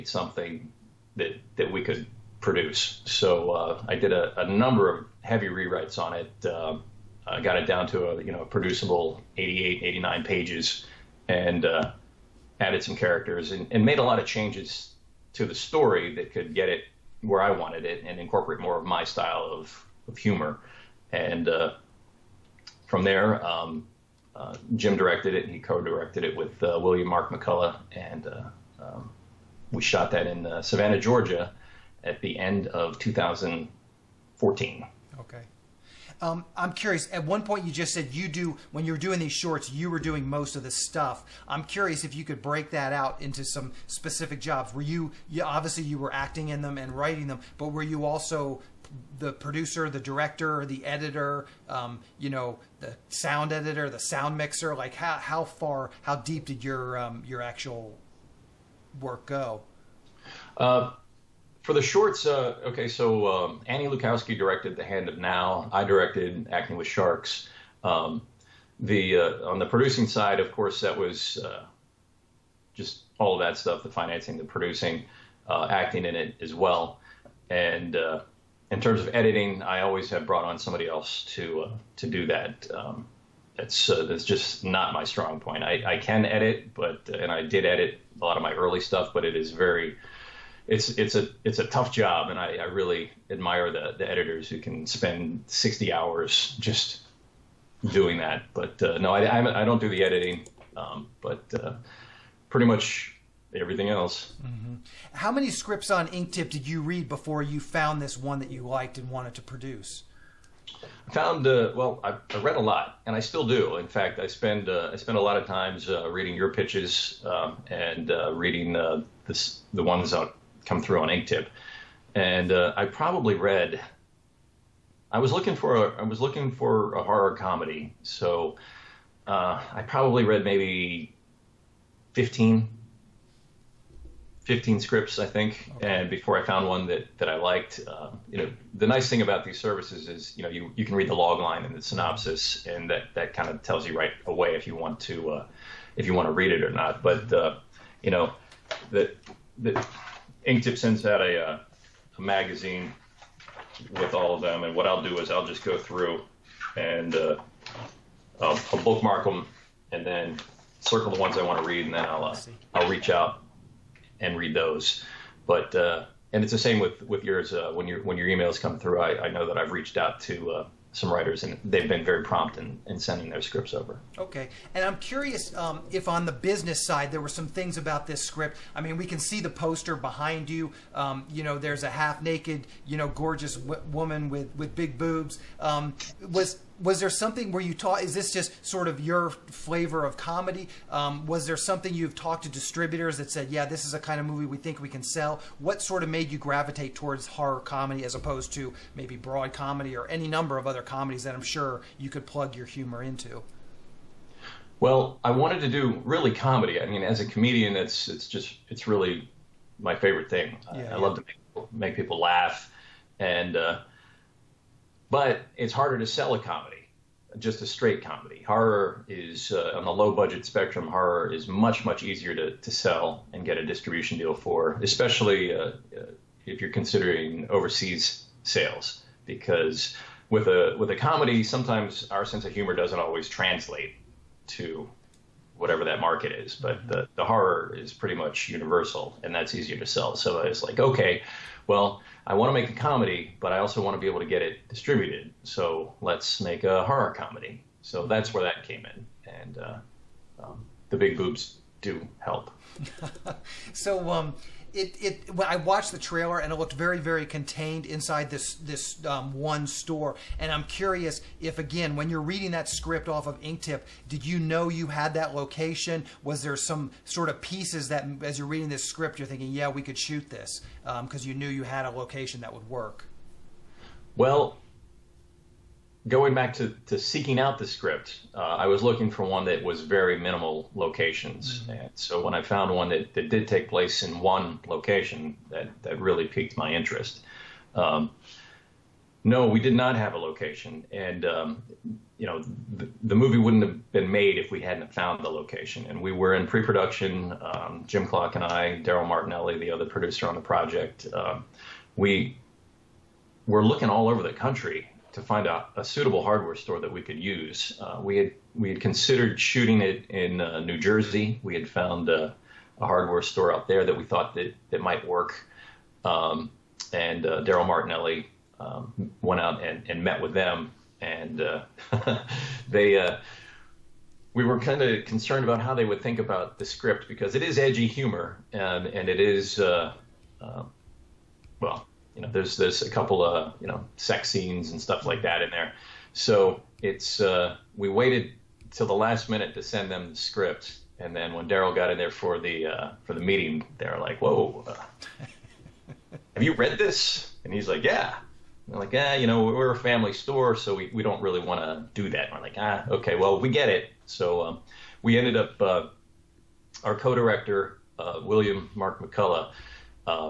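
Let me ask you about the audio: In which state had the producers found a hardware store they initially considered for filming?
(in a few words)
New Jersey.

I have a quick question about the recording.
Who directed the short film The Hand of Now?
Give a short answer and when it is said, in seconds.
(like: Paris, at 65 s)
Annie Lukowski, at 63 s.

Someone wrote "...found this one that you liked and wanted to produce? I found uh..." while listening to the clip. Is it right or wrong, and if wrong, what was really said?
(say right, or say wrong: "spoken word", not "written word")
right.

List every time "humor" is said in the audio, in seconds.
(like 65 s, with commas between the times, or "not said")
20 s, 202 s, 232 s, 327 s.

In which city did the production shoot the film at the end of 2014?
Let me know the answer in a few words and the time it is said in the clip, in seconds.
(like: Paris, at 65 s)
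Savannah, Georgia, at 30 s.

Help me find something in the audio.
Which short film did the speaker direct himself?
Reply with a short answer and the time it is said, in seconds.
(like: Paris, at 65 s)
Acting with Sharks, at 66 s.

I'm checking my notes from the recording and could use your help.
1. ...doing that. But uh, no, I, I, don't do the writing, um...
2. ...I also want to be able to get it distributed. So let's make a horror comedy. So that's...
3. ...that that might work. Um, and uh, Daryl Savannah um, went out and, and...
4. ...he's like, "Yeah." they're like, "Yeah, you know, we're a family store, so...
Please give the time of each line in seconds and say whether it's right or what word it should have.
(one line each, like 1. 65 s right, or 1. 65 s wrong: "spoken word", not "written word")
1. 97 s wrong: "editing", not "writing"
2. 243 s right
3. 314 s wrong: "Martinelli", not "Savannah"
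4. 347 s right.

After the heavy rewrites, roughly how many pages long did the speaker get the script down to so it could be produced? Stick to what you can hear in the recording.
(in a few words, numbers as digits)
88.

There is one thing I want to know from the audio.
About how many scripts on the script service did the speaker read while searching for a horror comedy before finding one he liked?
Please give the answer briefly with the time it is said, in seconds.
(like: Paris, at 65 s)
15, at 132 s.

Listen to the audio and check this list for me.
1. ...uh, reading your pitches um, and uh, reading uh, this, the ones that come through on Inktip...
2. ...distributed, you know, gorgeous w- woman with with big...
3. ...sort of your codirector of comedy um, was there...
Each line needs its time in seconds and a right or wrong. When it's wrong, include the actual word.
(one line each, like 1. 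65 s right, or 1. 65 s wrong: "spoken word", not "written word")
1. 115 s right
2. 182 s wrong: "naked", not "distributed"
3. 188 s wrong: "flavor", not "codirector".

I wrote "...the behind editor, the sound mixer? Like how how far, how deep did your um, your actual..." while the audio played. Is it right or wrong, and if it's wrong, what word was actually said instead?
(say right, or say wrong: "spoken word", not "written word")
wrong: "sound", not "behind".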